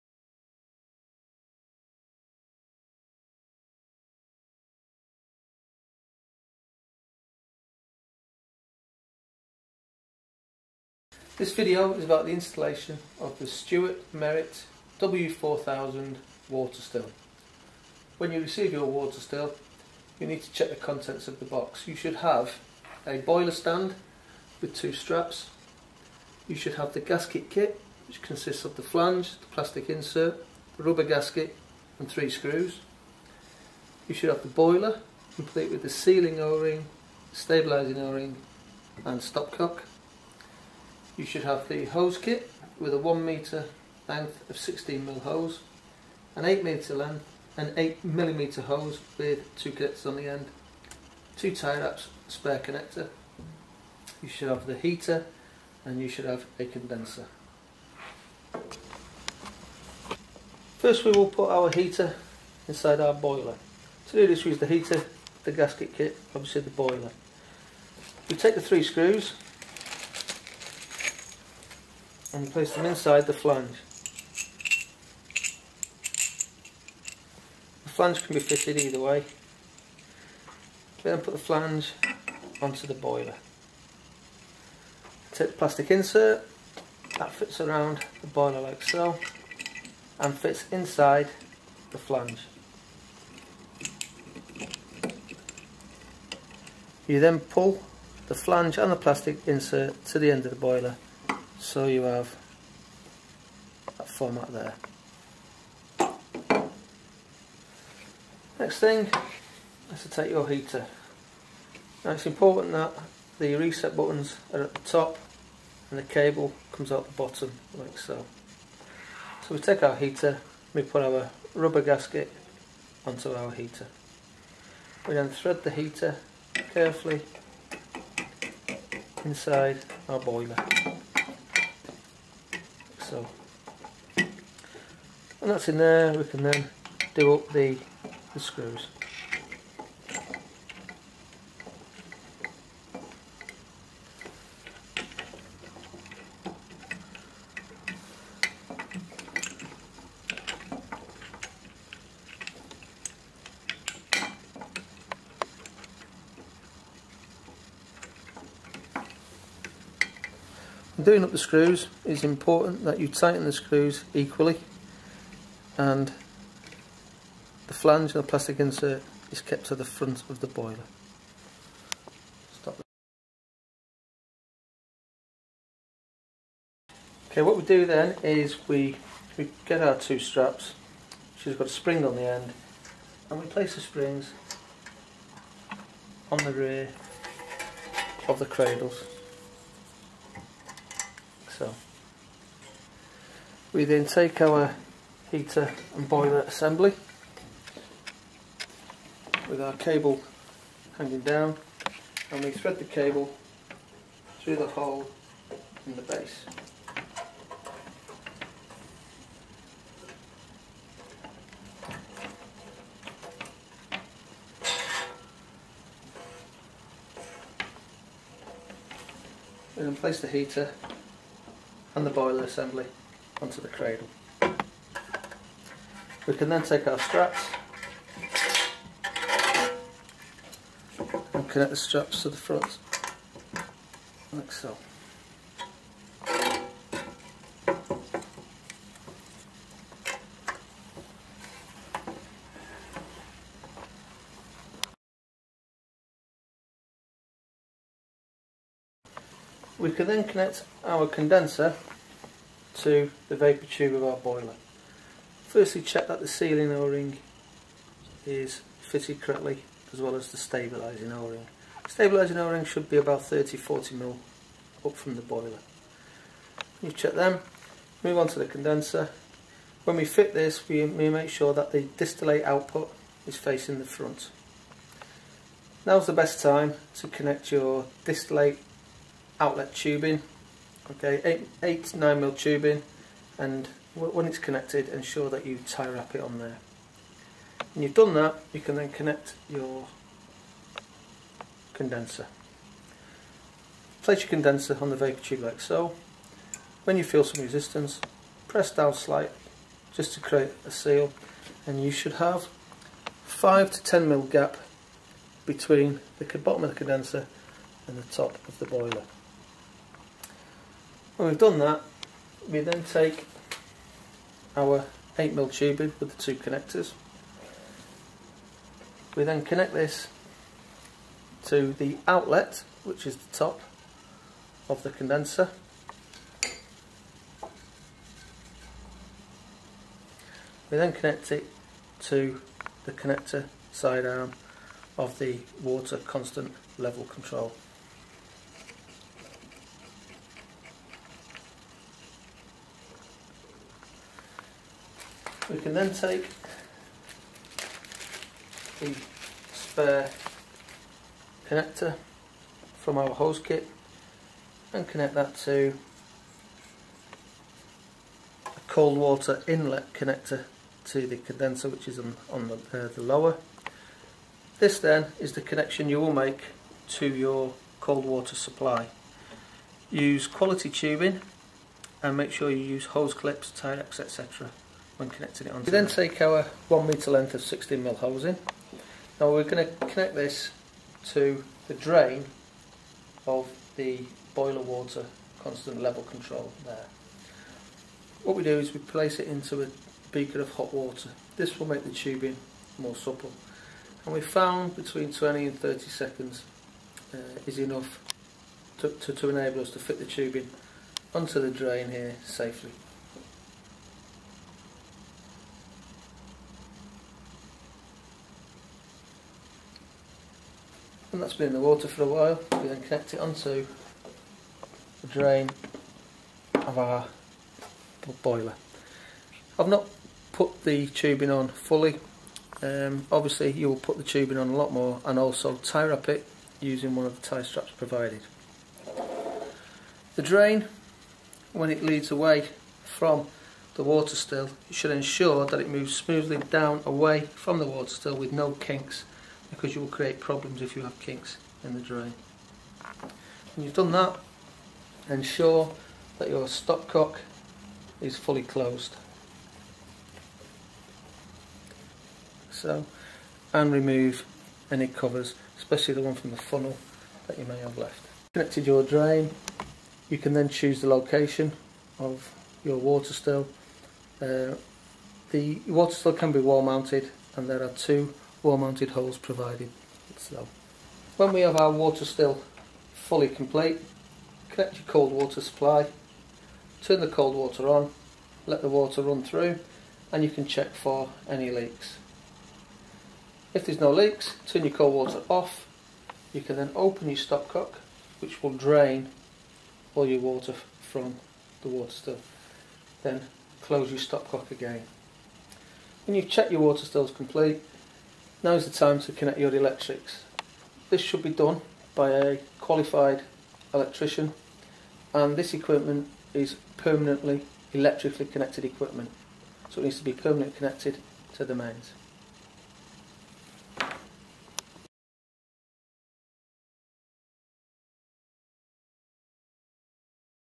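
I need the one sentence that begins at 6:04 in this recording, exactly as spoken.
This then is the connection you will make to your cold water supply.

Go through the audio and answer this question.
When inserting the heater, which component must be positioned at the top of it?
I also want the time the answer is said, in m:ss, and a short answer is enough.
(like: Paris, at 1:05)
reset buttons, at 1:53.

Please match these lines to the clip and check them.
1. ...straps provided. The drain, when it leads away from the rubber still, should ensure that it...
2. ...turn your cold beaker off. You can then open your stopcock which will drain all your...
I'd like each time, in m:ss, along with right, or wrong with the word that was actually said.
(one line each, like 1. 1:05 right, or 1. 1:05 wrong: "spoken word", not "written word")
1. 7:07 wrong: "water", not "rubber"
2. 8:04 wrong: "water", not "beaker".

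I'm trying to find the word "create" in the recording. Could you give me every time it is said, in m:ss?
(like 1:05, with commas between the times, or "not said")
5:00, 7:19.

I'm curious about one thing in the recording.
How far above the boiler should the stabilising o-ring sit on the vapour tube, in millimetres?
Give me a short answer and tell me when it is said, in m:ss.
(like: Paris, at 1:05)
30-40 mm, at 4:23.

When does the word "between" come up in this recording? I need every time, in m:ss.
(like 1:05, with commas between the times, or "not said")
5:05, 6:34.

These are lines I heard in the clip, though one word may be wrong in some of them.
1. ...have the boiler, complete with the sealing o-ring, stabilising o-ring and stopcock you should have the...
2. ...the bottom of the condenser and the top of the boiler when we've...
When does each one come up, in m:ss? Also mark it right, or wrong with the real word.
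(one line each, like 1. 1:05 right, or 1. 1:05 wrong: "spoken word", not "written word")
1. 0:34 right
2. 5:06 right.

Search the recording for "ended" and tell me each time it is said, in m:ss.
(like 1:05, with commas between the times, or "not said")
not said.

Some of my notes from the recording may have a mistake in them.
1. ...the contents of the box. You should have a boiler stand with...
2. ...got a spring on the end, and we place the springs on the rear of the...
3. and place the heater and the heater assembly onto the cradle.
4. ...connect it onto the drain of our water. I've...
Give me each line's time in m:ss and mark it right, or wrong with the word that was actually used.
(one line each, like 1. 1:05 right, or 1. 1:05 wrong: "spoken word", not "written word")
1. 0:20 right
2. 3:01 right
3. 3:39 wrong: "boiler", not "heater"
4. 6:52 wrong: "boiler", not "water".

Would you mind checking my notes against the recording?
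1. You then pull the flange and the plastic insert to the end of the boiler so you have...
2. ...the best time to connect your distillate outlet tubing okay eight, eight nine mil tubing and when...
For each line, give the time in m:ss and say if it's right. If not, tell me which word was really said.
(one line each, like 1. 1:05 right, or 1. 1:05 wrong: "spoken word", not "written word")
1. 1:37 right
2. 4:36 right.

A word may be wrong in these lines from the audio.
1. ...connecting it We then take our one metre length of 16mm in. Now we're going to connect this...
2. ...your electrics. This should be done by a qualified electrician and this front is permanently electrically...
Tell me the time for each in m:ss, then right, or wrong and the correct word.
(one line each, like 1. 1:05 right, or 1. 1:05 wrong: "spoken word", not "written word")
1. 6:15 right
2. 8:19 wrong: "equipment", not "front".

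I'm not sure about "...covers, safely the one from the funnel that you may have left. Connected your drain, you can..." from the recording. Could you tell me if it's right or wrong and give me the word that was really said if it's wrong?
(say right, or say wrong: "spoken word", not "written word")
wrong: "especially", not "safely".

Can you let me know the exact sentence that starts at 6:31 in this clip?
This will make the tubing more supple.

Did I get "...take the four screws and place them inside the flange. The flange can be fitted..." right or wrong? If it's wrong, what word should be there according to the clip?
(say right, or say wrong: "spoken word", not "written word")
wrong: "three", not "four".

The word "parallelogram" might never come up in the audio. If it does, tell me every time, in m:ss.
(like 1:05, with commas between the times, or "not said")
not said.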